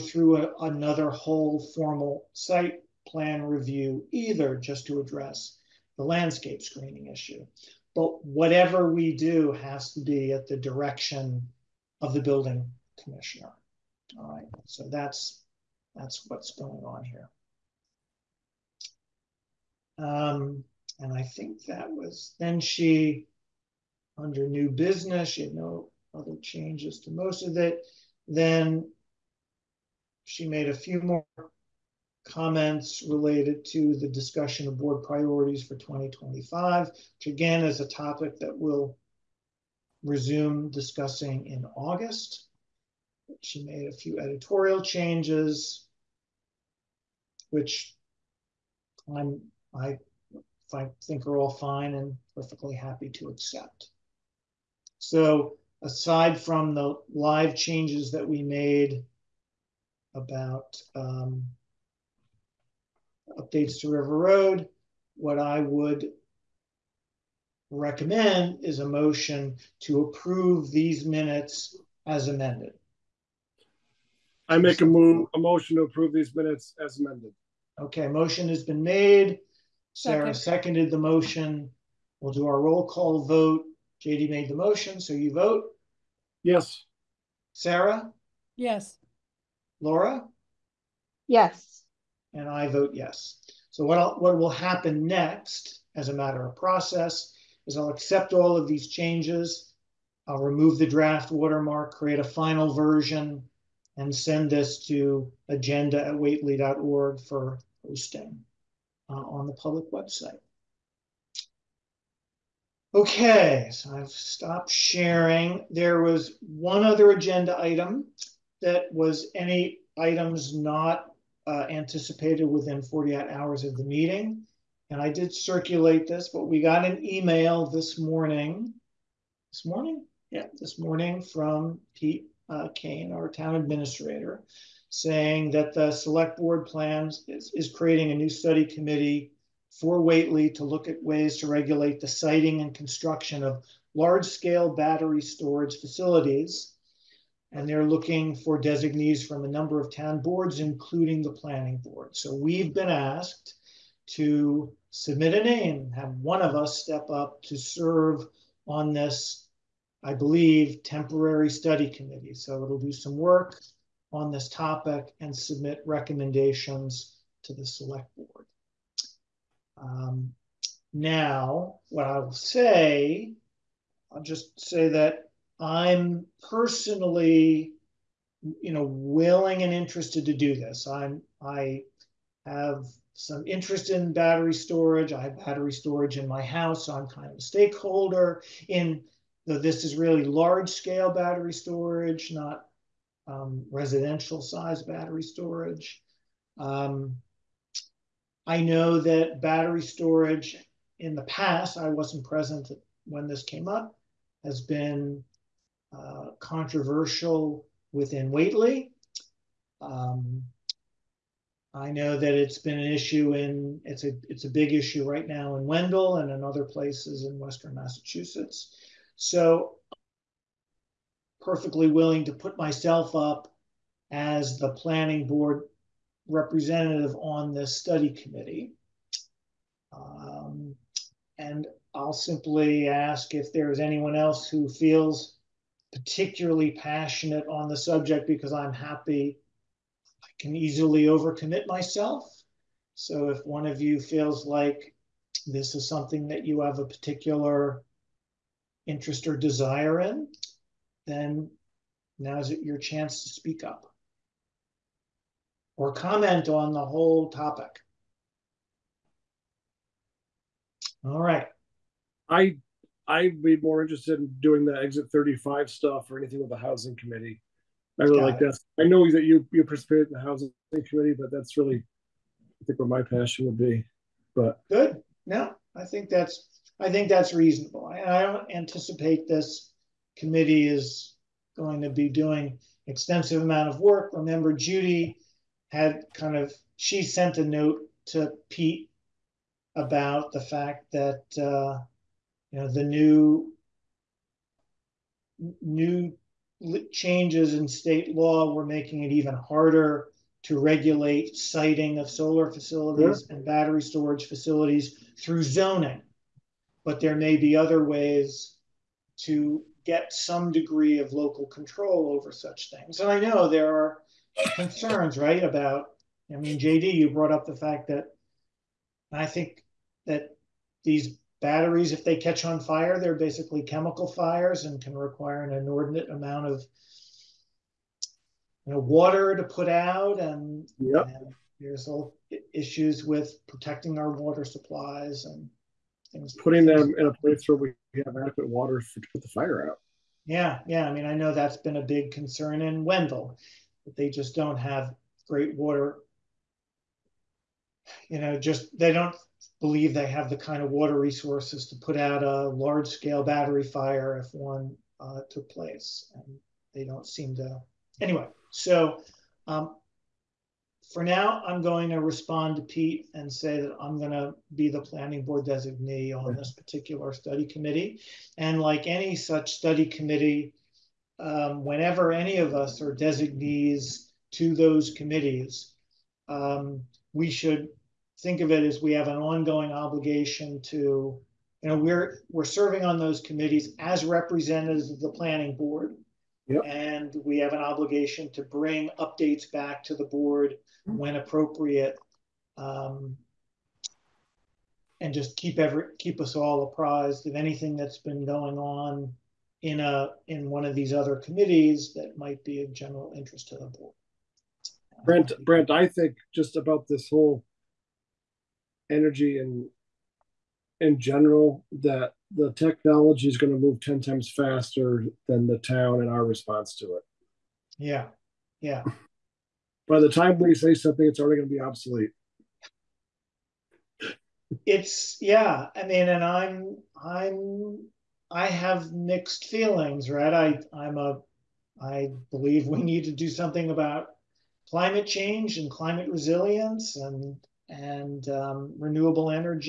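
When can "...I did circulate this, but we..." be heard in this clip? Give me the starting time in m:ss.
2:05.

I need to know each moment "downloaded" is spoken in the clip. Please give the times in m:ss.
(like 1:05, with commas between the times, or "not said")
not said.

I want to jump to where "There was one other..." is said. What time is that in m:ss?
1:55.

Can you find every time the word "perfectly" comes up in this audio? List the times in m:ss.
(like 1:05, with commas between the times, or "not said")
0:52, 3:41.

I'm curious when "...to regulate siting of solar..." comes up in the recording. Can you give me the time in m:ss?
5:00.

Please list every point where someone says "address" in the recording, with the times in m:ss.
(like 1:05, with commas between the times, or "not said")
0:05.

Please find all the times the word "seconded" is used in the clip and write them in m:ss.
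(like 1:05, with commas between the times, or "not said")
1:20.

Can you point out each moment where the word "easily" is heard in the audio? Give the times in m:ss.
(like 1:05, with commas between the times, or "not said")
4:00.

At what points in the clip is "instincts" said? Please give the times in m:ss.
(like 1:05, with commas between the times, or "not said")
not said.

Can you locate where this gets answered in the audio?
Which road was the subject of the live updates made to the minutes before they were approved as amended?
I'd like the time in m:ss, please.
1:03.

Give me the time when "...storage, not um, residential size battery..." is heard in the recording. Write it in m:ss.
3:11.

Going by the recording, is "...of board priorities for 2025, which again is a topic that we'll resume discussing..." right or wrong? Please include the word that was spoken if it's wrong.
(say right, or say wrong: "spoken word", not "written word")
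right.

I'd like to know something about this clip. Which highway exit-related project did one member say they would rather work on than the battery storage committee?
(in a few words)
Exit 35.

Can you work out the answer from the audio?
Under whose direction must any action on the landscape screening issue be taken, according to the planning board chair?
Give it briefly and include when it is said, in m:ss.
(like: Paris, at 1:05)
Building commissioner, at 0:12.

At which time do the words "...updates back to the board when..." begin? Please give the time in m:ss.
6:28.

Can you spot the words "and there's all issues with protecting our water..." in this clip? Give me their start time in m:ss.
5:31.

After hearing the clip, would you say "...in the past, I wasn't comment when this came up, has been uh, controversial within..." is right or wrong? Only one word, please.
wrong.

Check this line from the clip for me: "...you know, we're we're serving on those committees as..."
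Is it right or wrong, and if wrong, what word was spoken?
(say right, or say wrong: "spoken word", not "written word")
right.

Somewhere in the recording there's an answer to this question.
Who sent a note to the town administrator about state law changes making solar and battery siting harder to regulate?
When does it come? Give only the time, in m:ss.
4:44.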